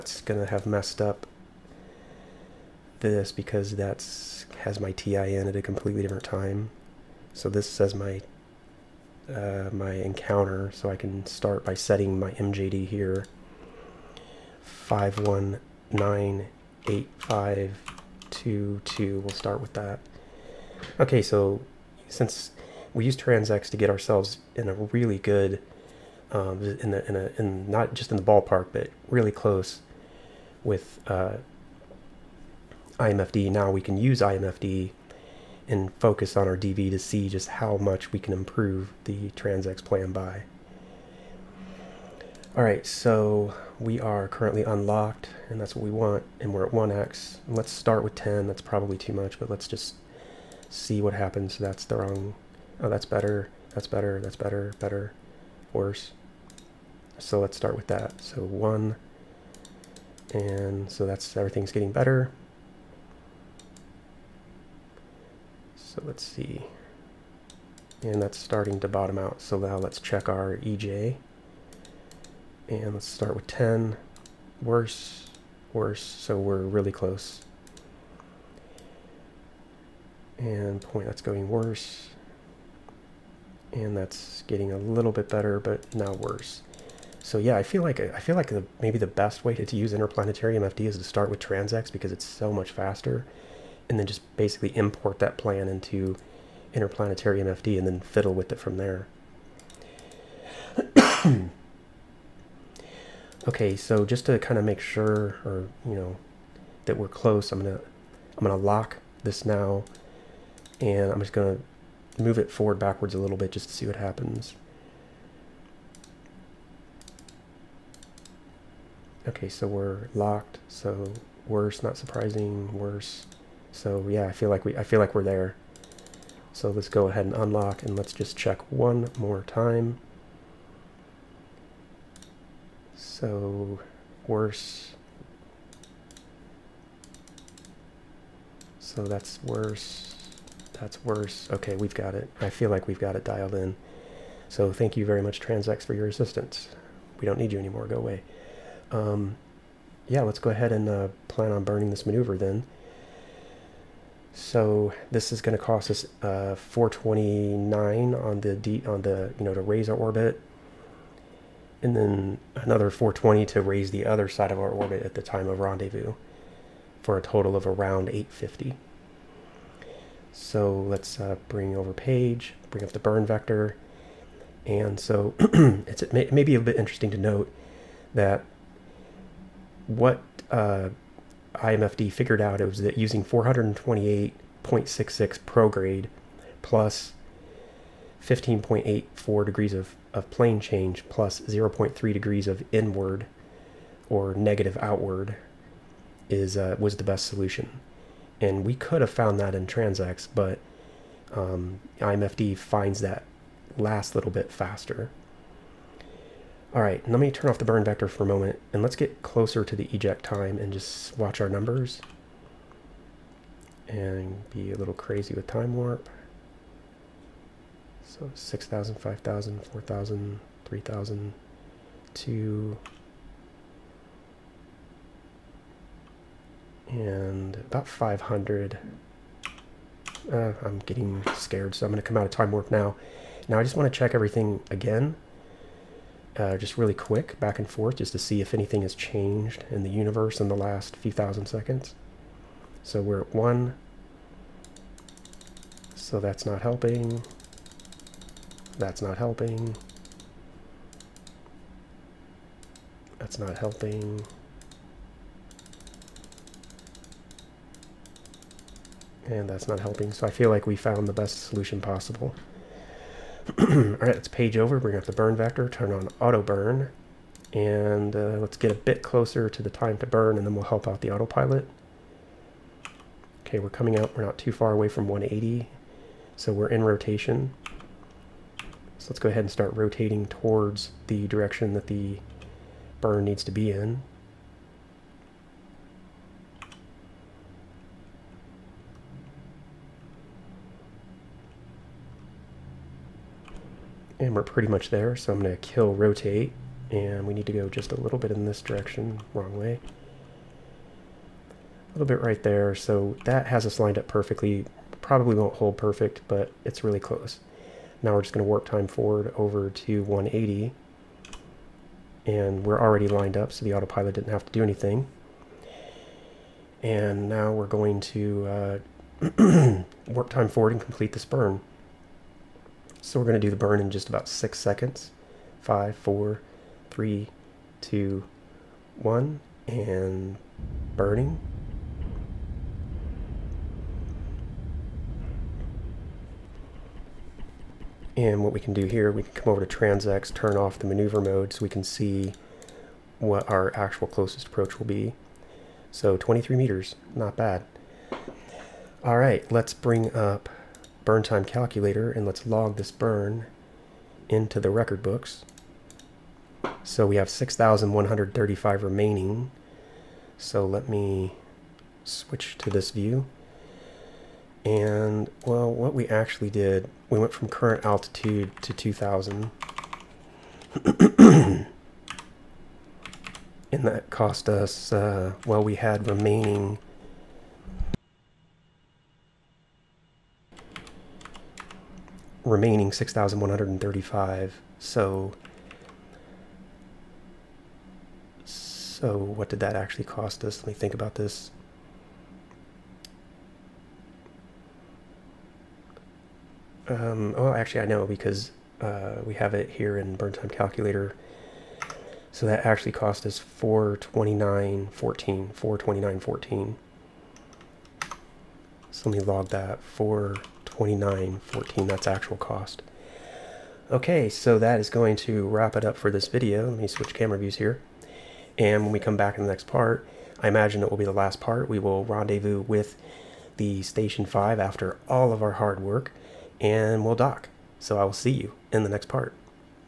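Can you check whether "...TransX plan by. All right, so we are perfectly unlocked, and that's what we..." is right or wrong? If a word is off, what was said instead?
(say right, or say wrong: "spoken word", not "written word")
wrong: "currently", not "perfectly".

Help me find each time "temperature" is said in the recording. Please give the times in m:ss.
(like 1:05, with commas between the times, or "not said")
not said.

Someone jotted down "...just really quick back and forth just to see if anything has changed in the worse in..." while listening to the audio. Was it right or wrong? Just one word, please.
wrong.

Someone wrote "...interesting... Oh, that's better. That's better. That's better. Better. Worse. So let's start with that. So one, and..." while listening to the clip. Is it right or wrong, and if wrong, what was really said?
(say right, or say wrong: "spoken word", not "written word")
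wrong: "wrong", not "interesting".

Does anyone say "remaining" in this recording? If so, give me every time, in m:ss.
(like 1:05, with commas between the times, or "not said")
5:58, 6:16, 6:22.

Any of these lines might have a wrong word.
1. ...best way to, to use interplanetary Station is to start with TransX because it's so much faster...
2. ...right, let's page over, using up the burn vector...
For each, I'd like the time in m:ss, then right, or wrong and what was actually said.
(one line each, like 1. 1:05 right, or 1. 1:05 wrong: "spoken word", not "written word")
1. 1:29 wrong: "MFD", not "Station"
2. 4:23 wrong: "bring", not "using".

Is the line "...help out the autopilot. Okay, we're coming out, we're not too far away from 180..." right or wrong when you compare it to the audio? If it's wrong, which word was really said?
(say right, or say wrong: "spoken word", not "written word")
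right.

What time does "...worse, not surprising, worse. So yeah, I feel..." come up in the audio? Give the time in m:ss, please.
2:01.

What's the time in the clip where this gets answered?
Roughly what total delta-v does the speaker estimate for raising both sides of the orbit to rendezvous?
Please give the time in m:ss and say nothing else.
2:47.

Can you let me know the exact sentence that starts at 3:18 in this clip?
And we could have found that in TransX, but um, IMFD finds that last little bit faster.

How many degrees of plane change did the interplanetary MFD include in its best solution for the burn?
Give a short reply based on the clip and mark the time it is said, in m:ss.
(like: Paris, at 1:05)
15.84, at 3:08.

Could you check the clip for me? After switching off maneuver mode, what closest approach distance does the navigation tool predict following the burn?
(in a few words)
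23 meters.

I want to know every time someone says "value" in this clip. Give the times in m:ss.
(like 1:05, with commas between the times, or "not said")
not said.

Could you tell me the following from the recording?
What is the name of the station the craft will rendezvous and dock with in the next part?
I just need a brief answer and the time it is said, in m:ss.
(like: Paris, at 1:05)
Station 5, at 7:03.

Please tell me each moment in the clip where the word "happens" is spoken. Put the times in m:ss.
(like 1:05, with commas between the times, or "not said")
0:51, 1:53.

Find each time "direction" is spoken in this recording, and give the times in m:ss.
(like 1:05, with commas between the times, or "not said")
4:41, 4:58.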